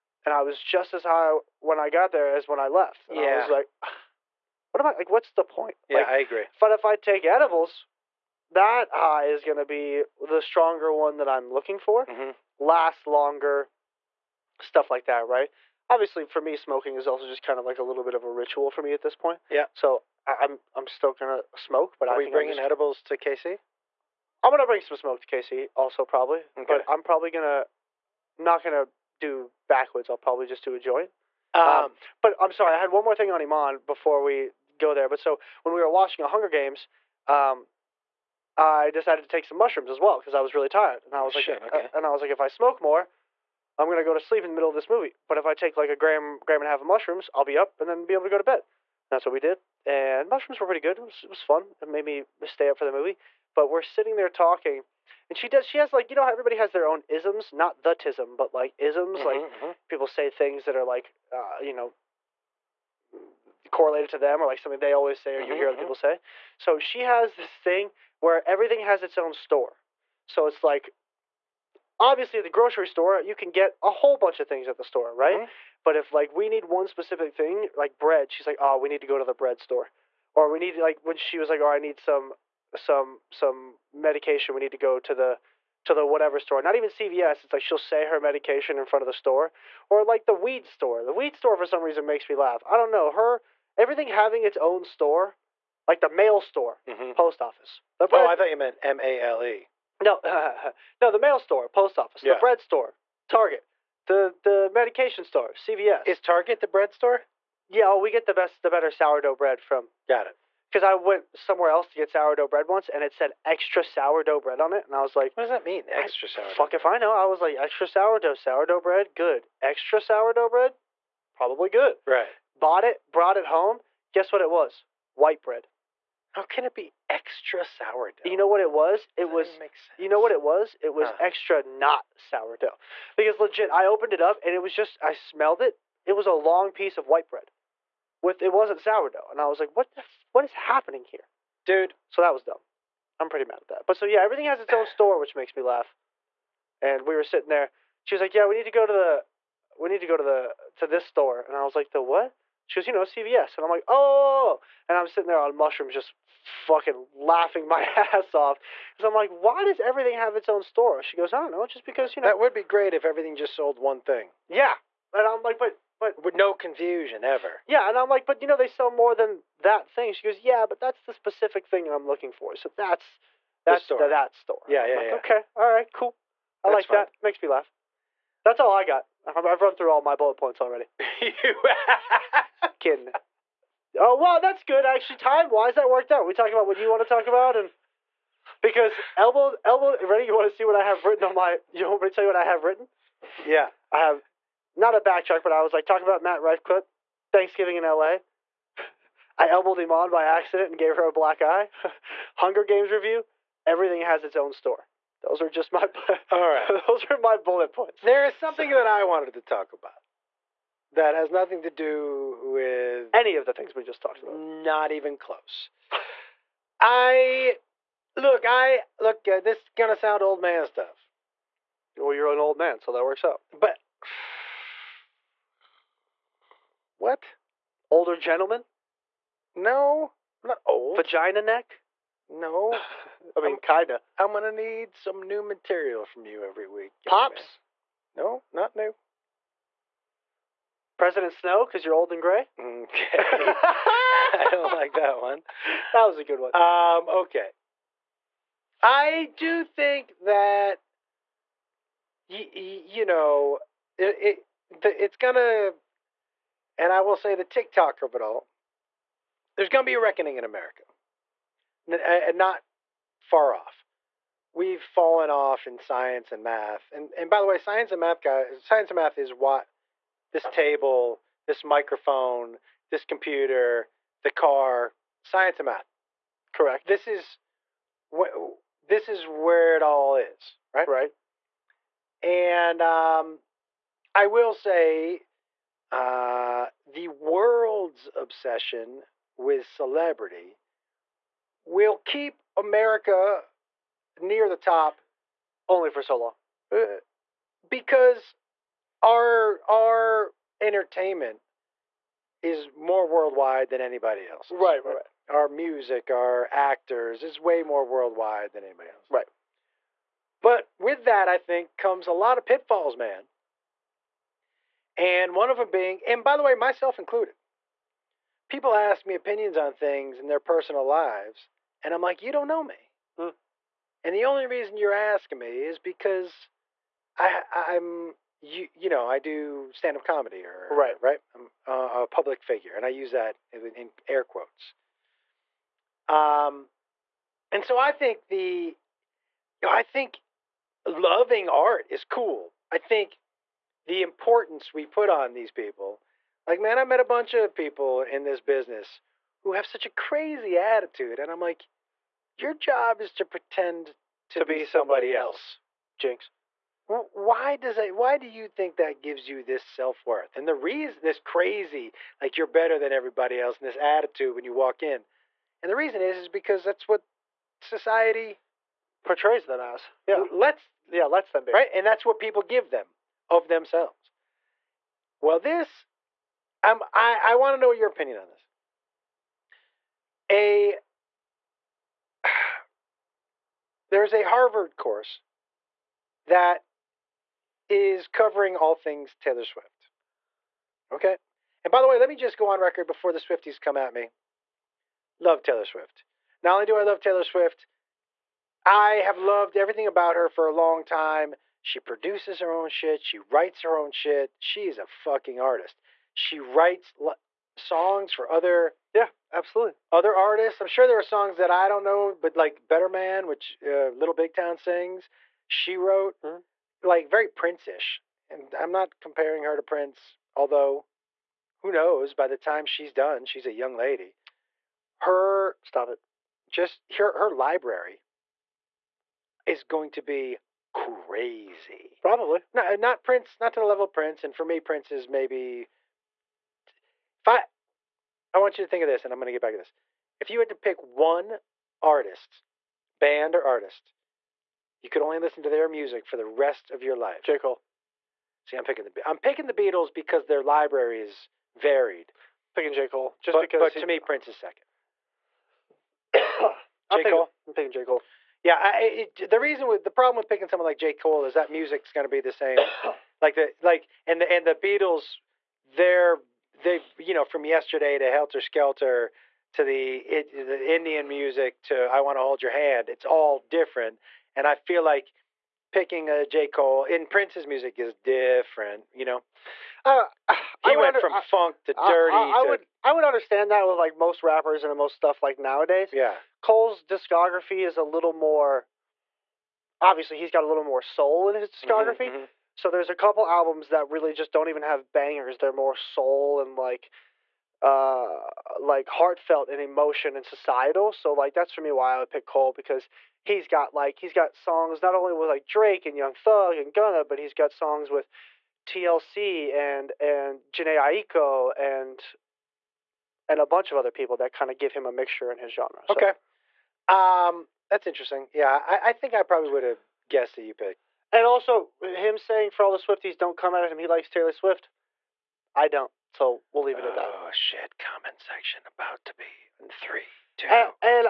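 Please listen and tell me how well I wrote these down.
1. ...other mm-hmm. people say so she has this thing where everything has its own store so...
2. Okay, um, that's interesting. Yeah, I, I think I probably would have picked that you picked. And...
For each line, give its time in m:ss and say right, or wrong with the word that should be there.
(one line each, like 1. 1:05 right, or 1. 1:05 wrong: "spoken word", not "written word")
1. 1:05 right
2. 8:35 wrong: "guessed", not "picked".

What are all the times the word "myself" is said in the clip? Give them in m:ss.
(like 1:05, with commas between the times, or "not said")
5:16.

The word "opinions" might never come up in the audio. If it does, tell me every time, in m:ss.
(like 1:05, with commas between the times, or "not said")
5:19, 6:17.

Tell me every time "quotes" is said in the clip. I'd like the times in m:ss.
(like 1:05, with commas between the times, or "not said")
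5:34.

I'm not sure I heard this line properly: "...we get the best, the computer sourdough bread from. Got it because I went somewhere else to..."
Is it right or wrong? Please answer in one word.
wrong.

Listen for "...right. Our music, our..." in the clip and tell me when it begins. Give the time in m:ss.
5:04.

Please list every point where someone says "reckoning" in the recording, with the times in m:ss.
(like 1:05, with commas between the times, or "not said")
4:19.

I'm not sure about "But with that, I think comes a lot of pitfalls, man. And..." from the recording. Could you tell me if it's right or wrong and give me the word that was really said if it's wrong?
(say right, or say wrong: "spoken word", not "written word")
right.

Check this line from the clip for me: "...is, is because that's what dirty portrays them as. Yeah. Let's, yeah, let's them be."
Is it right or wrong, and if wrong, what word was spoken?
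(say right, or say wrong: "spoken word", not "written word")
wrong: "society", not "dirty".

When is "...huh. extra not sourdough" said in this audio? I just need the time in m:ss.
2:11.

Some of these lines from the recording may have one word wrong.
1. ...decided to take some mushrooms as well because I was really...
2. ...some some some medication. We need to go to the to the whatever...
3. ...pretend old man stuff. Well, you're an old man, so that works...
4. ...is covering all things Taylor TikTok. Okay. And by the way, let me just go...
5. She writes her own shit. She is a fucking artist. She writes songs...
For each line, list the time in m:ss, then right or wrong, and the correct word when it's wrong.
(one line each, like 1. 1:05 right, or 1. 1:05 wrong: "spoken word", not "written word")
1. 0:38 right
2. 1:21 right
3. 3:39 wrong: "sound", not "pretend"
4. 6:27 wrong: "Swift", not "TikTok"
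5. 6:43 right.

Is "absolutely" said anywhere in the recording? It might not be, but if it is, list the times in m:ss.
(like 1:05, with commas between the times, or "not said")
6:49.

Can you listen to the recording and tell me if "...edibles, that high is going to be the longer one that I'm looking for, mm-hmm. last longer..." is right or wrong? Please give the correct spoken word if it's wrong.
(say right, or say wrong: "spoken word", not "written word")
wrong: "stronger", not "longer".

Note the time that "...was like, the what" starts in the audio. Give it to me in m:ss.
2:31.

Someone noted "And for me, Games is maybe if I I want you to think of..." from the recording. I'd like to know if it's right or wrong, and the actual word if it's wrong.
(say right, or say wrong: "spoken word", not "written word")
wrong: "Prince", not "Games".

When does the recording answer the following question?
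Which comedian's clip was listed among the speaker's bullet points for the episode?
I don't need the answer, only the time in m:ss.
3:16.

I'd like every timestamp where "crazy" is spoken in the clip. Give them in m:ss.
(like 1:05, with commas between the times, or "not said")
5:49, 6:01, 7:10.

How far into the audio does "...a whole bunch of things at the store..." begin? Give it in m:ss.
1:13.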